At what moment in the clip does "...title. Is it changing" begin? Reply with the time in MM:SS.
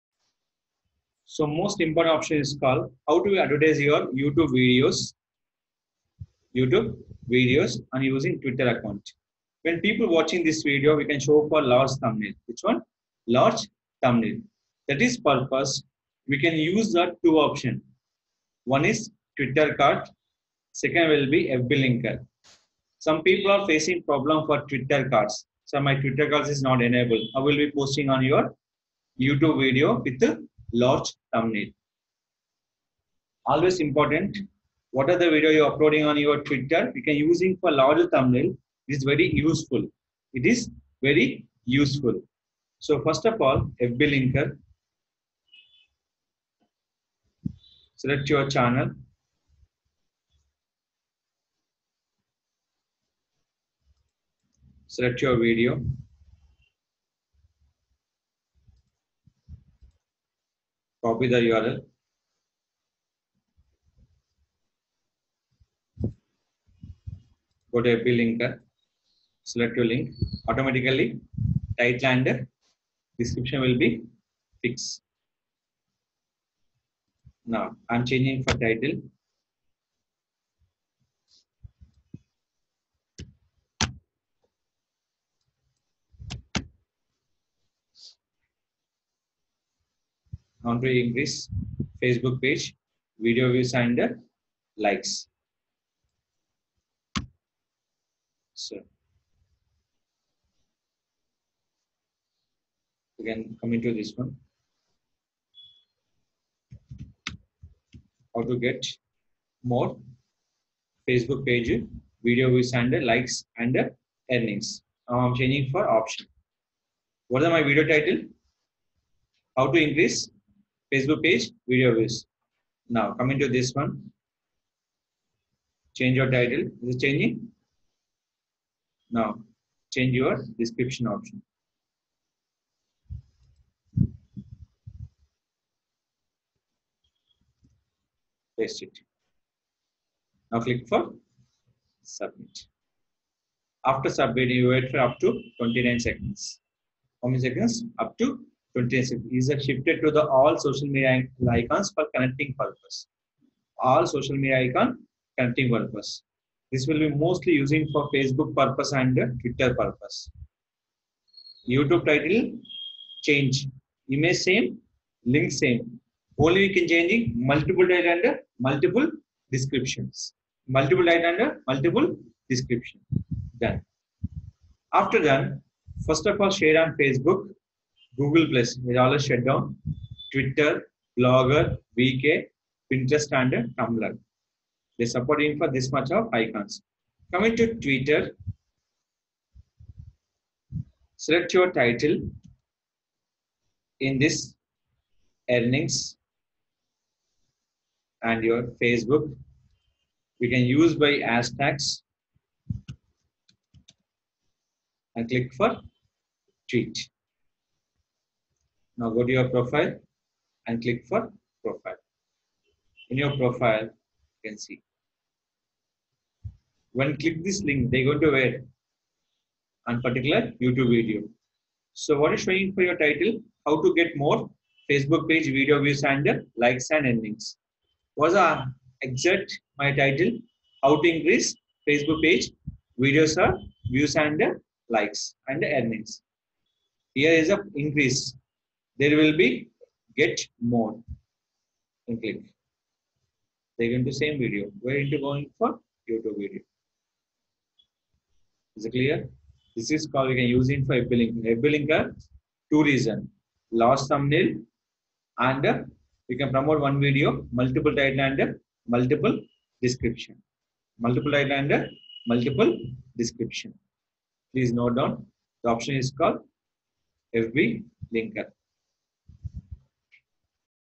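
02:06.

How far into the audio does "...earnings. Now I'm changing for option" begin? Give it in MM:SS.
01:54.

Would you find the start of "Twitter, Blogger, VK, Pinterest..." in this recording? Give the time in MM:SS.
03:00.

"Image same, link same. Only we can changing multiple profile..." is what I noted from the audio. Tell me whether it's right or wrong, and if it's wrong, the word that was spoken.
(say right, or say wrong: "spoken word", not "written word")
wrong: "title", not "profile".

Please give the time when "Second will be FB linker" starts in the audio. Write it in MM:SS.
00:20.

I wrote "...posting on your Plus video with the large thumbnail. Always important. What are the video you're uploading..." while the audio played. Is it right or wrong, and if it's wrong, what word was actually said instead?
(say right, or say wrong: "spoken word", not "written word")
wrong: "YouTube", not "Plus".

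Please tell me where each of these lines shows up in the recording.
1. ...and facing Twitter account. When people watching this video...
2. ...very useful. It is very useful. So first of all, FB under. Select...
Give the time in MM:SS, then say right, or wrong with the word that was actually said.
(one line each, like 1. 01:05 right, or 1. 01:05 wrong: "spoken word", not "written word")
1. 00:07 wrong: "using", not "facing"
2. 00:39 wrong: "linker", not "under".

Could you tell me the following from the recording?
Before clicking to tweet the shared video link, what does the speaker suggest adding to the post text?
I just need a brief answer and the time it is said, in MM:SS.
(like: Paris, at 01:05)
hashtags, at 03:21.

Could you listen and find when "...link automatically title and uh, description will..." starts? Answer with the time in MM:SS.
01:09.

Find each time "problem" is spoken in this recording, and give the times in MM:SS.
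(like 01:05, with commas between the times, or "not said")
00:24.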